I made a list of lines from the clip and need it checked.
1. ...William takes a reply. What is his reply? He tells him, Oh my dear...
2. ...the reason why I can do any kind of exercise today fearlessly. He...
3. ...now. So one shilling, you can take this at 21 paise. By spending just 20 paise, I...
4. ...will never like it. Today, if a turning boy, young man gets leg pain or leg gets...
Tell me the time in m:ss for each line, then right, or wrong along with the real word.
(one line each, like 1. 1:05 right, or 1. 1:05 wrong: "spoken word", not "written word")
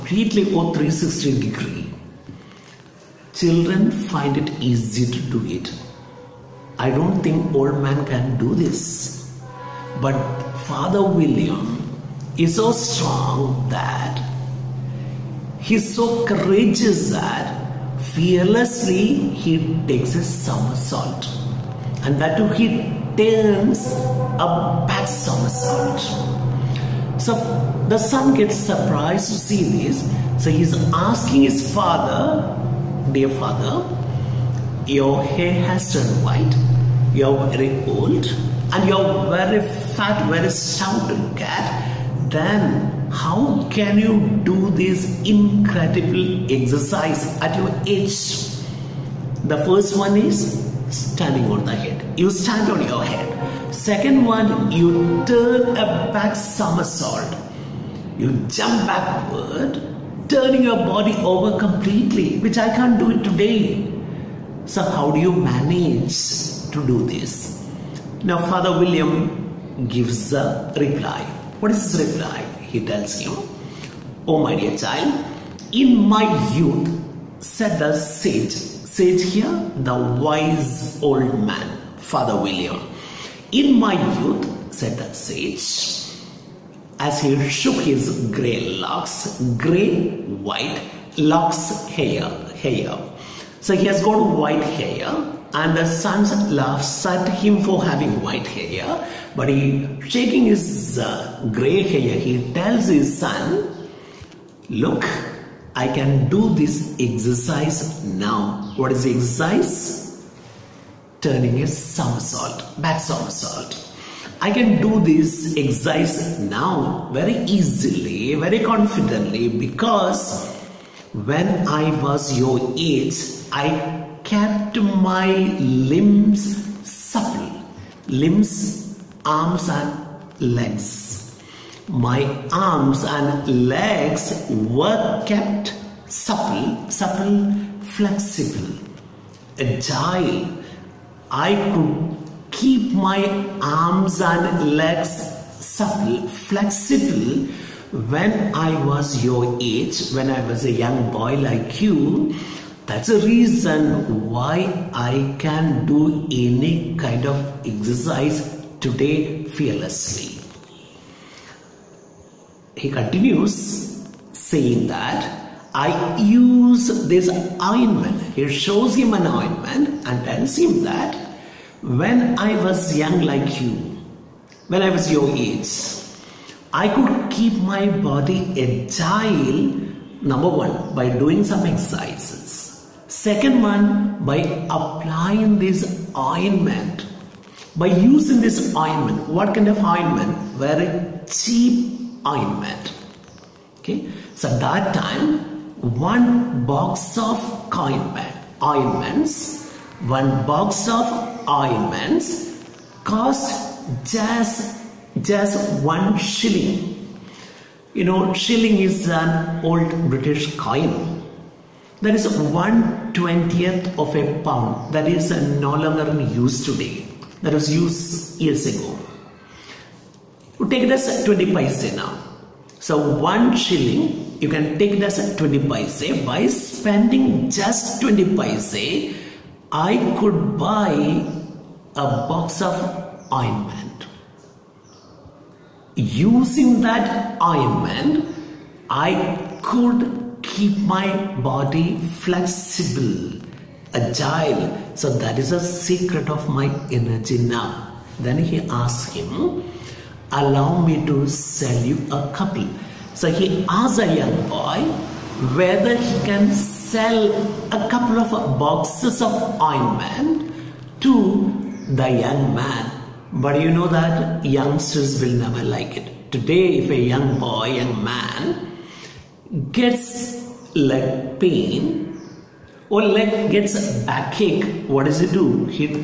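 1. 1:08 wrong: "gives", not "takes"
2. 2:33 right
3. 3:41 wrong: "20", not "21"
4. 4:25 wrong: "young", not "turning".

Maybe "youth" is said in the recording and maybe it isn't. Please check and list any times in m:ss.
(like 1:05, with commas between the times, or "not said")
1:16, 1:24.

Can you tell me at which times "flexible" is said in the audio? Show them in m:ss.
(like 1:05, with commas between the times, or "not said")
2:17, 2:26, 4:02.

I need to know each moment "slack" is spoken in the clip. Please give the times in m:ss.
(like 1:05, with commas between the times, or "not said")
not said.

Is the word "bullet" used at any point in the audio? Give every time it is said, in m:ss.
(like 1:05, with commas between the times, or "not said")
not said.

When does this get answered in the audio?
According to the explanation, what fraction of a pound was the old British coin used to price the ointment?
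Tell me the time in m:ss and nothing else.
3:32.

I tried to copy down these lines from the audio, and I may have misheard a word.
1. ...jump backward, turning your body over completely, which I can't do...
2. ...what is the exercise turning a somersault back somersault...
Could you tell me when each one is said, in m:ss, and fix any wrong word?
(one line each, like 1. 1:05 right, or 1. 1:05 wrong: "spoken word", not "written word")
1. 0:58 right
2. 1:48 right.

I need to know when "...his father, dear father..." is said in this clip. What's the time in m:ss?
0:31.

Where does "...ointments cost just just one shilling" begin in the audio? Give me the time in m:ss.
3:21.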